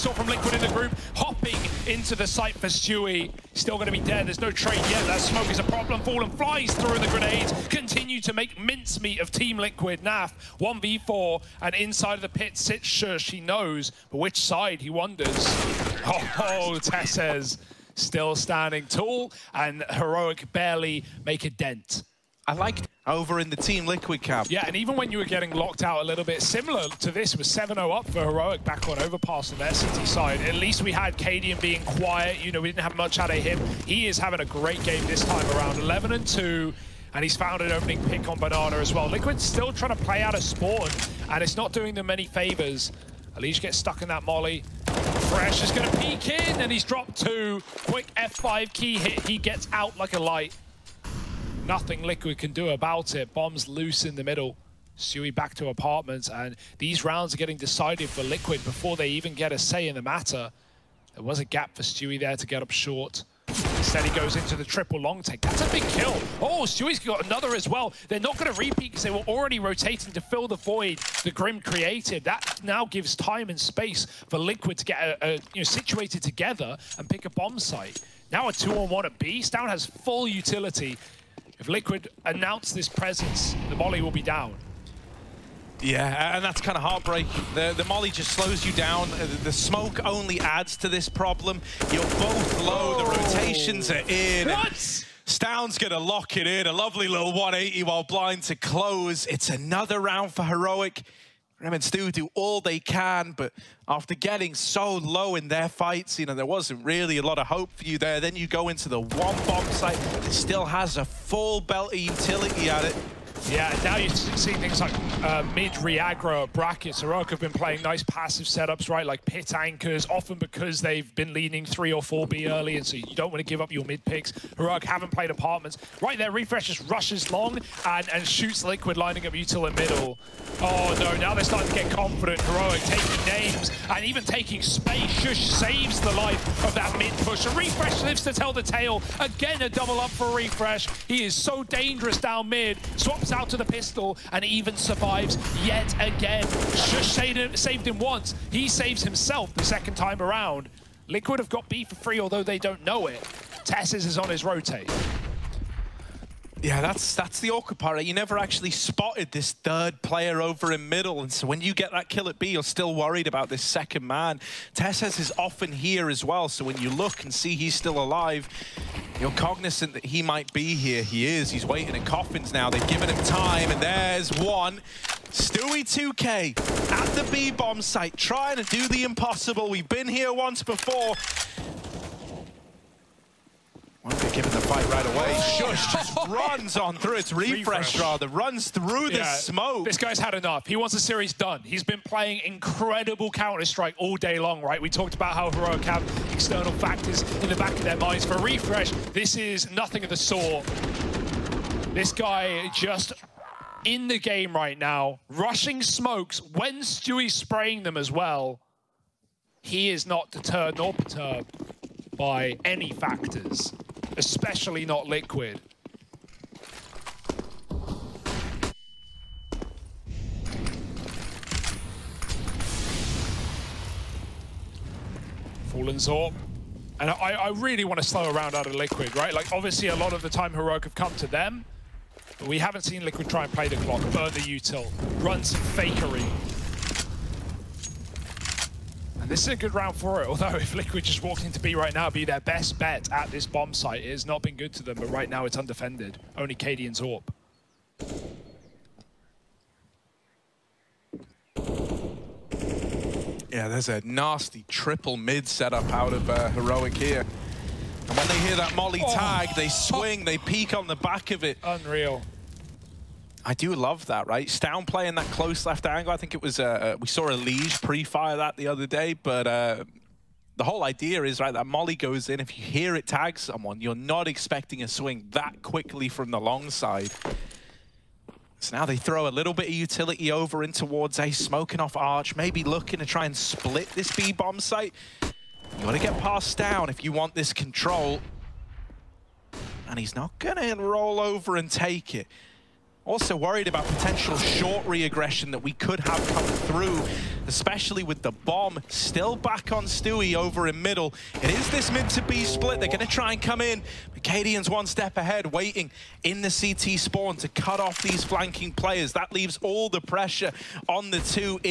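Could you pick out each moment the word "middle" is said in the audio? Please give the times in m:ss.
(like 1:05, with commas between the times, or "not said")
0:54, 2:09, 2:40, 5:00.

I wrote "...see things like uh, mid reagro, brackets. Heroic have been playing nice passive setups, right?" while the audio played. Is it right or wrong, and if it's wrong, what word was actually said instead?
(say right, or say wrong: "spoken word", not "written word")
right.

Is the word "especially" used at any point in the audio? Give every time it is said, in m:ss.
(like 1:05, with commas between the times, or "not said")
3:34, 4:57.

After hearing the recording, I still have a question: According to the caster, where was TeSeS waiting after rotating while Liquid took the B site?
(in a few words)
Coffins.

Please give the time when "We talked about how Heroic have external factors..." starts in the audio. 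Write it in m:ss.
3:14.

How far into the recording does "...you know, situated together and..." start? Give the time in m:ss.
1:15.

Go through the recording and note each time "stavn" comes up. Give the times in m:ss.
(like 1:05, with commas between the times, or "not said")
1:35, 4:24.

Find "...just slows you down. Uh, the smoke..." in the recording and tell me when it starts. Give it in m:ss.
1:28.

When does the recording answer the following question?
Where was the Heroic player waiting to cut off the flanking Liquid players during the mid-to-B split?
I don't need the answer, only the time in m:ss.
5:06.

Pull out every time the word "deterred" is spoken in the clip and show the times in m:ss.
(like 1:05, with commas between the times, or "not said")
3:30.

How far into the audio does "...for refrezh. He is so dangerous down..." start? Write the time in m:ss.
2:20.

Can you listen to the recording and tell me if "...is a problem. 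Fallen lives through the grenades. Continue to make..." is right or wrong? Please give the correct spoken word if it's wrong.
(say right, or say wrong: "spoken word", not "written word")
wrong: "flies", not "lives".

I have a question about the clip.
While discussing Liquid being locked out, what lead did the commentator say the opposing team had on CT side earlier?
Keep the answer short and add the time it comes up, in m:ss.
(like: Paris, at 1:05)
7-0, at 0:27.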